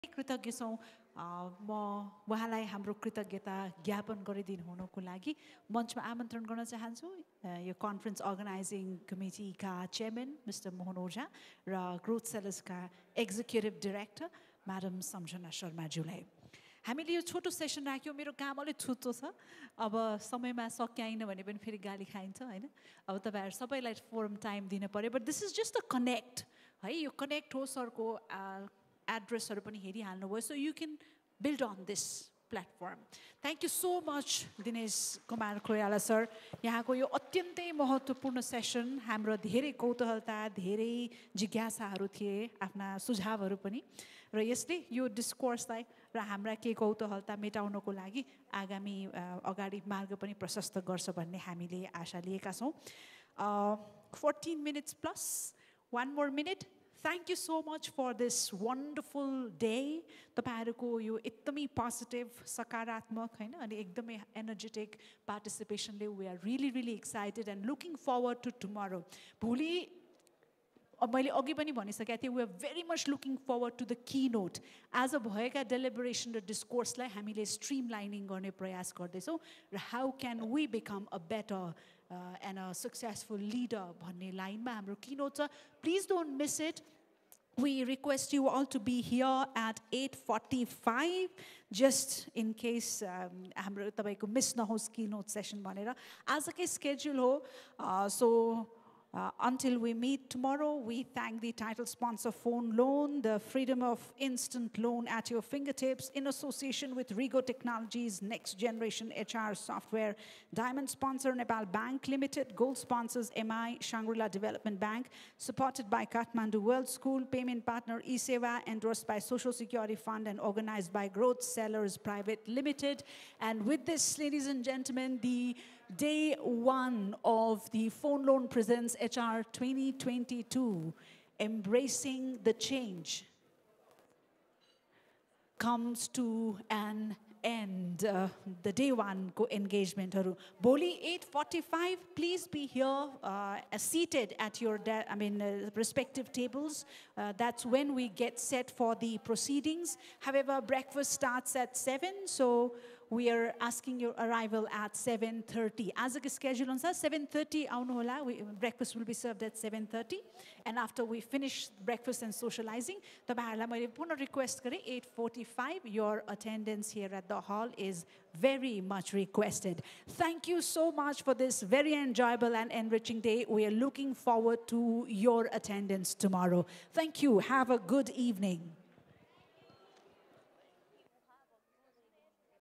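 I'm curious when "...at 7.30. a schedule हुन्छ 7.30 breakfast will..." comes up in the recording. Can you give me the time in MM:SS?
02:34.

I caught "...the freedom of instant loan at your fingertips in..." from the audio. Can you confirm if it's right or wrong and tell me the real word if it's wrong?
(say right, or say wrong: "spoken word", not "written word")
right.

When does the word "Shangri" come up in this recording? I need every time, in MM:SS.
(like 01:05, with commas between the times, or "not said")
01:53.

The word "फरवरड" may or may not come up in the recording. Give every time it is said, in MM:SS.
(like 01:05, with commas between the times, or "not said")
01:08, 01:13.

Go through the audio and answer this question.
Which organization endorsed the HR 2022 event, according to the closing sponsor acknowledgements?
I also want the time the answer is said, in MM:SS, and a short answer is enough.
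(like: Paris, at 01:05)
Social Security Fund, at 01:59.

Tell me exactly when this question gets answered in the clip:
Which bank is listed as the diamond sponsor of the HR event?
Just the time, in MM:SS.
01:51.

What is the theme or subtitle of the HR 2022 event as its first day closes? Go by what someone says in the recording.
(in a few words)
Embracing the Change.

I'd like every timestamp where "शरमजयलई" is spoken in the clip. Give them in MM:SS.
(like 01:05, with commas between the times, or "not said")
00:15.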